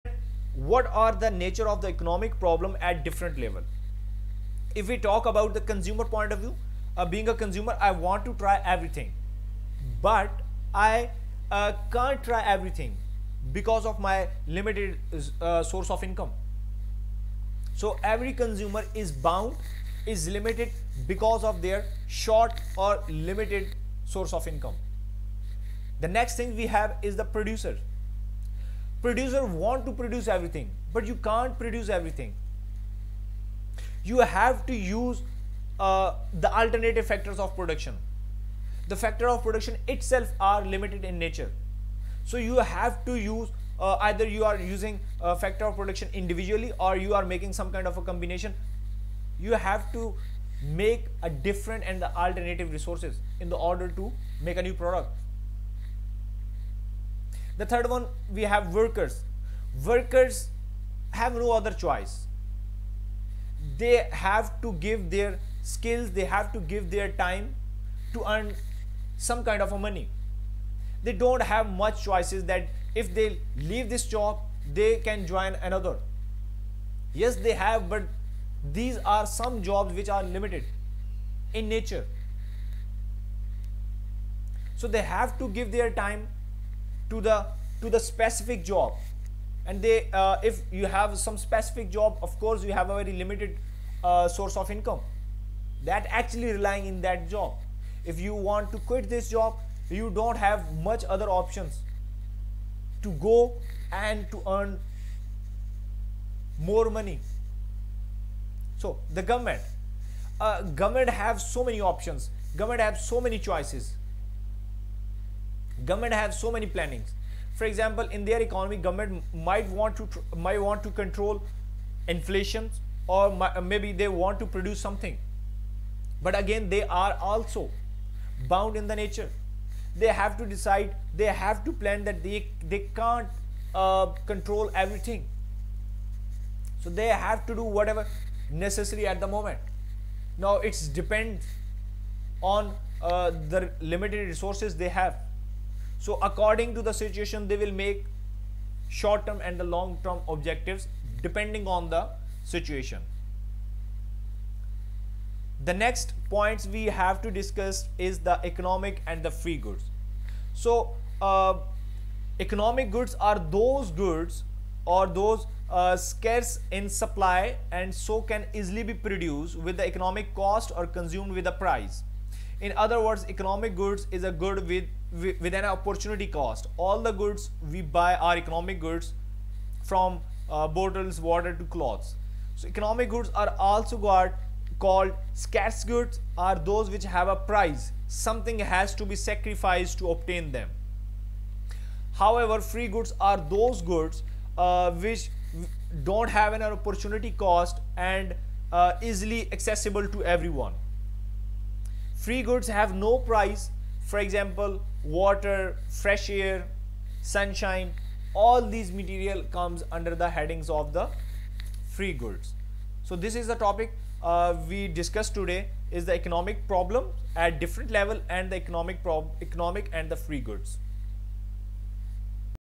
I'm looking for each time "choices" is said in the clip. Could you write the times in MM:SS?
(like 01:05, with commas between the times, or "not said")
01:01, 01:12, 01:53.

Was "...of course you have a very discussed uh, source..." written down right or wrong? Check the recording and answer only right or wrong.
wrong.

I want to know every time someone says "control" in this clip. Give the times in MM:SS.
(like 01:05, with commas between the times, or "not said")
02:00, 02:14.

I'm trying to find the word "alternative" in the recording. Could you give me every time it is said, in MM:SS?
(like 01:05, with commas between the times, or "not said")
00:36, 00:52.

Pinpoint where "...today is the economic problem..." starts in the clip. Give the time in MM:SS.
03:35.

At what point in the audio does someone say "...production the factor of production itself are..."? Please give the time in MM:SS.
00:37.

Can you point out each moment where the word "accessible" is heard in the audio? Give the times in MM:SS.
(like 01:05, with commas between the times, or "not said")
03:19.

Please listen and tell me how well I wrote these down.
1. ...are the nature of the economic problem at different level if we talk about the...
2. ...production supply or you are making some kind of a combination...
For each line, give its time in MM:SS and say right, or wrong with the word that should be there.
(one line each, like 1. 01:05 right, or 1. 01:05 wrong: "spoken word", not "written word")
1. 00:00 right
2. 00:45 wrong: "individually", not "supply".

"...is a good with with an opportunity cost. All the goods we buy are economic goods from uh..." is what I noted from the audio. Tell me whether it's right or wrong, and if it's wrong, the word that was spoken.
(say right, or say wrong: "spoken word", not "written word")
right.